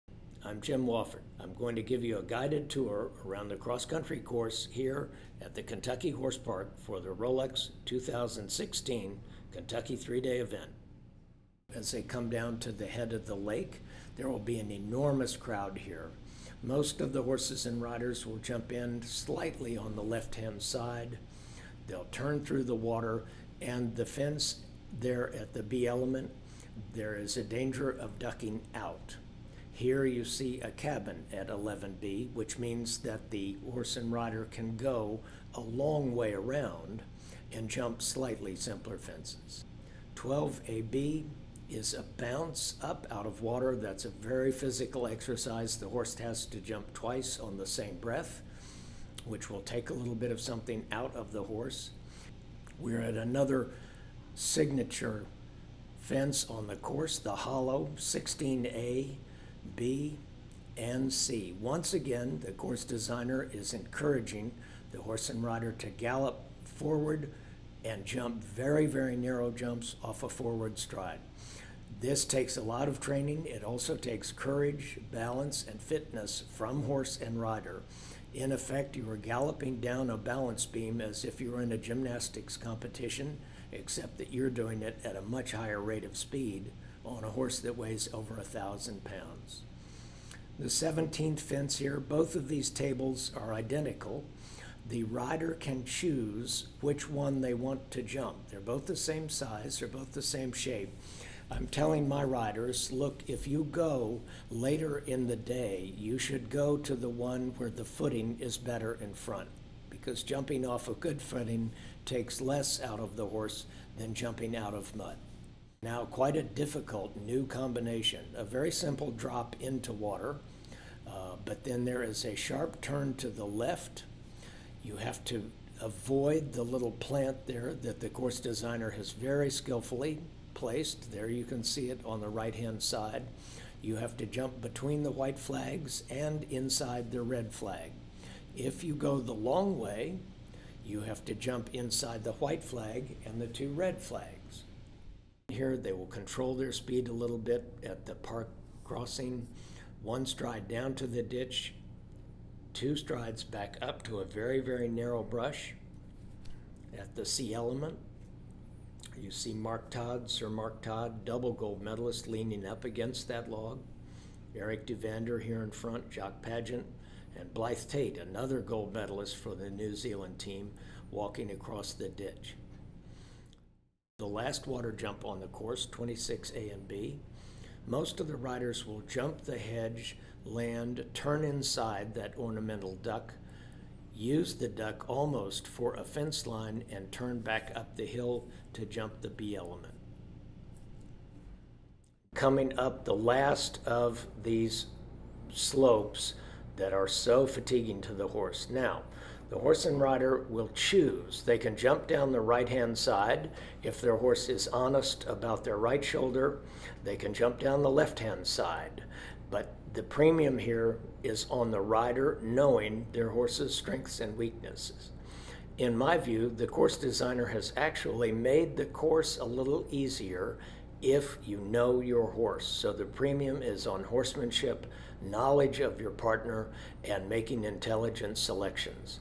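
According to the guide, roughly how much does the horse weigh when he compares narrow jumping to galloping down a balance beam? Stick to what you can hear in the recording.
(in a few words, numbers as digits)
Over 1,000 pounds.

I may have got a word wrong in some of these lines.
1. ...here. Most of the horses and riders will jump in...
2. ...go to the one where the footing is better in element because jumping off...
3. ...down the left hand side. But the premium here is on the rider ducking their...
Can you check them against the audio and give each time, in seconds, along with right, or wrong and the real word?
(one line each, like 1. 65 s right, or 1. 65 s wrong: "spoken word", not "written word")
1. 15 s right
2. 106 s wrong: "front", not "element"
3. 207 s wrong: "knowing", not "ducking".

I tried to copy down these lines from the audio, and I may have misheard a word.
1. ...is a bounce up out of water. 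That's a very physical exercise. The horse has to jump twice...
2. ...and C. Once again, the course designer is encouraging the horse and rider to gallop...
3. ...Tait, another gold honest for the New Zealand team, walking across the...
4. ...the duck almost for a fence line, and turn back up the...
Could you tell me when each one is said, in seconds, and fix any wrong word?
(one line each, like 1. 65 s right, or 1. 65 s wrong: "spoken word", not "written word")
1. 41 s right
2. 60 s right
3. 167 s wrong: "medalist", not "honest"
4. 184 s right.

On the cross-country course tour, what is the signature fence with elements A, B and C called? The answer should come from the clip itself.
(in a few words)
The hollow.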